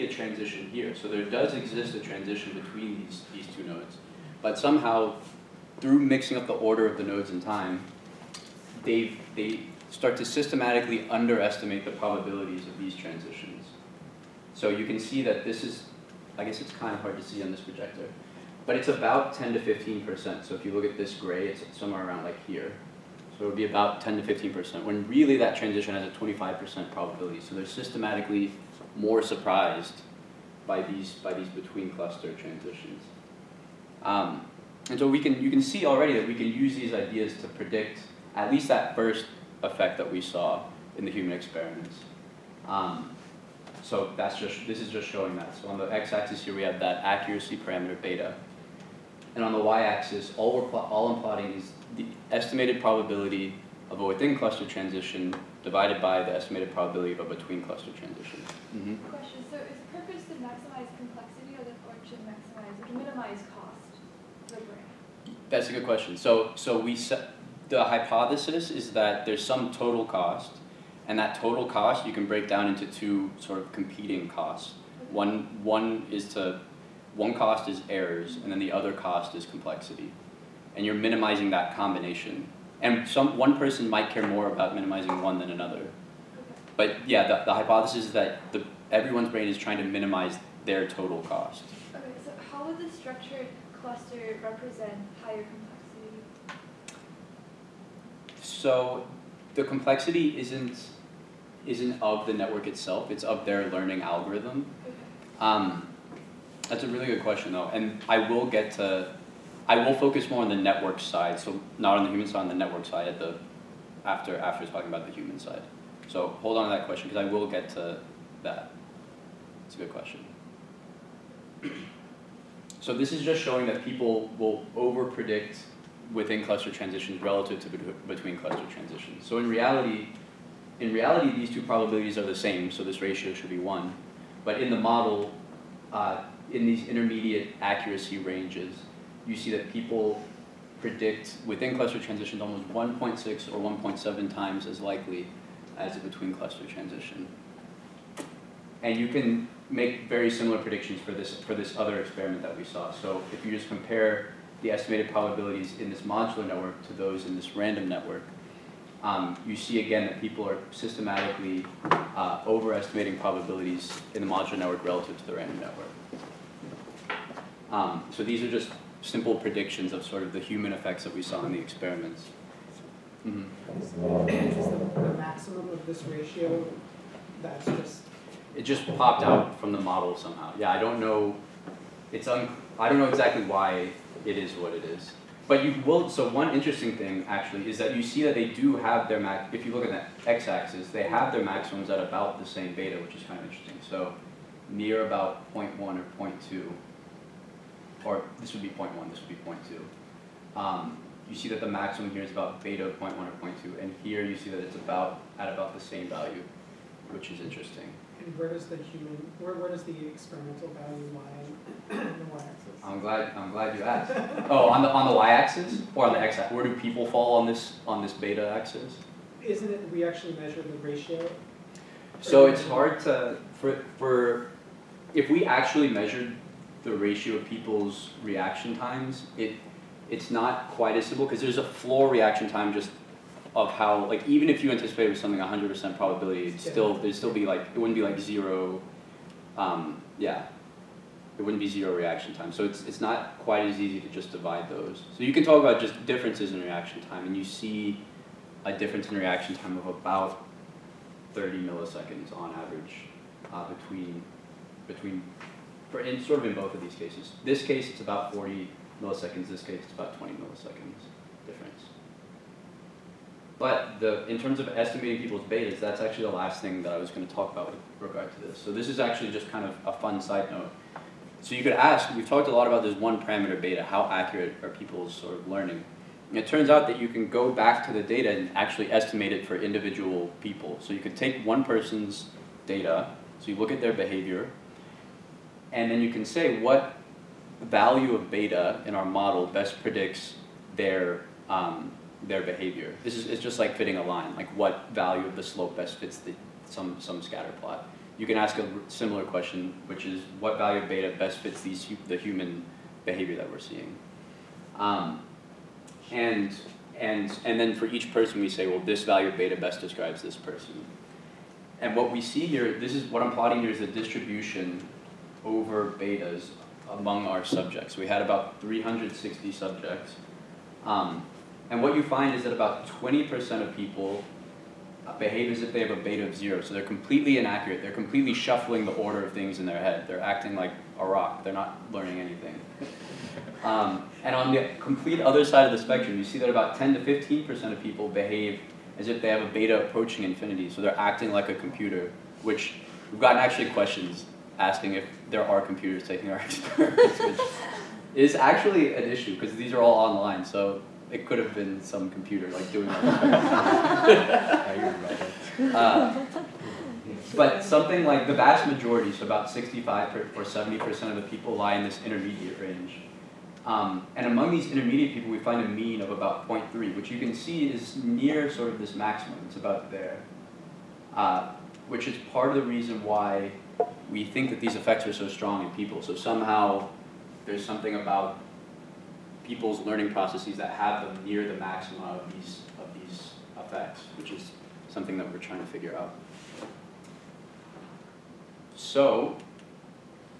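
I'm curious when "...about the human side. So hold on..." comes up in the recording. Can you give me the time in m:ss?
1:54.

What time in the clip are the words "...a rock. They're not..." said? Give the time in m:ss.
5:30.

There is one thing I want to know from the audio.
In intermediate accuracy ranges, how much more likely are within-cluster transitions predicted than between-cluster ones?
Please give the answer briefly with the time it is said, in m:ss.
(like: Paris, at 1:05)
1.6 or 1.7, at 2:22.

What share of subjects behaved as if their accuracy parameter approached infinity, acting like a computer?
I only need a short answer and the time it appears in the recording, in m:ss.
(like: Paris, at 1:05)
10 to 15%, at 5:36.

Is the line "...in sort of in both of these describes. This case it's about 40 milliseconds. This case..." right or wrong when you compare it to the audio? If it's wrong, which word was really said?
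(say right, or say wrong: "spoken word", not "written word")
wrong: "cases", not "describes".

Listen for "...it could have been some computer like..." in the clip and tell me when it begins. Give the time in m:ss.
5:51.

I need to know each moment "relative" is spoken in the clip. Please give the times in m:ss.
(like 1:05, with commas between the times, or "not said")
2:07, 2:44.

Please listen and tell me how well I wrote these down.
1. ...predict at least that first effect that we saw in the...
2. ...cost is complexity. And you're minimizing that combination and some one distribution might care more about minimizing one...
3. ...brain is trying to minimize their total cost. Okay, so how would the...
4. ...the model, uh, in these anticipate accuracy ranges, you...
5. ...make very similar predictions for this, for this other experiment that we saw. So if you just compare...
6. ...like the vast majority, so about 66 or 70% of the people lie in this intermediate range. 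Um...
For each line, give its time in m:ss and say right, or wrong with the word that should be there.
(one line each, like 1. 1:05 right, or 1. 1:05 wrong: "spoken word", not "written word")
1. 0:37 right
2. 1:18 wrong: "person", not "distribution"
3. 1:29 right
4. 2:14 wrong: "intermediate", not "anticipate"
5. 2:29 right
6. 5:58 wrong: "65", not "66".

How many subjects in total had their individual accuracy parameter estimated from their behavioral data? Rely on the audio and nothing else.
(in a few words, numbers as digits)
360.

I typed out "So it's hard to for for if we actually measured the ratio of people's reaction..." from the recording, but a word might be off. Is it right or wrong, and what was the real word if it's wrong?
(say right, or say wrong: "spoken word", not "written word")
right.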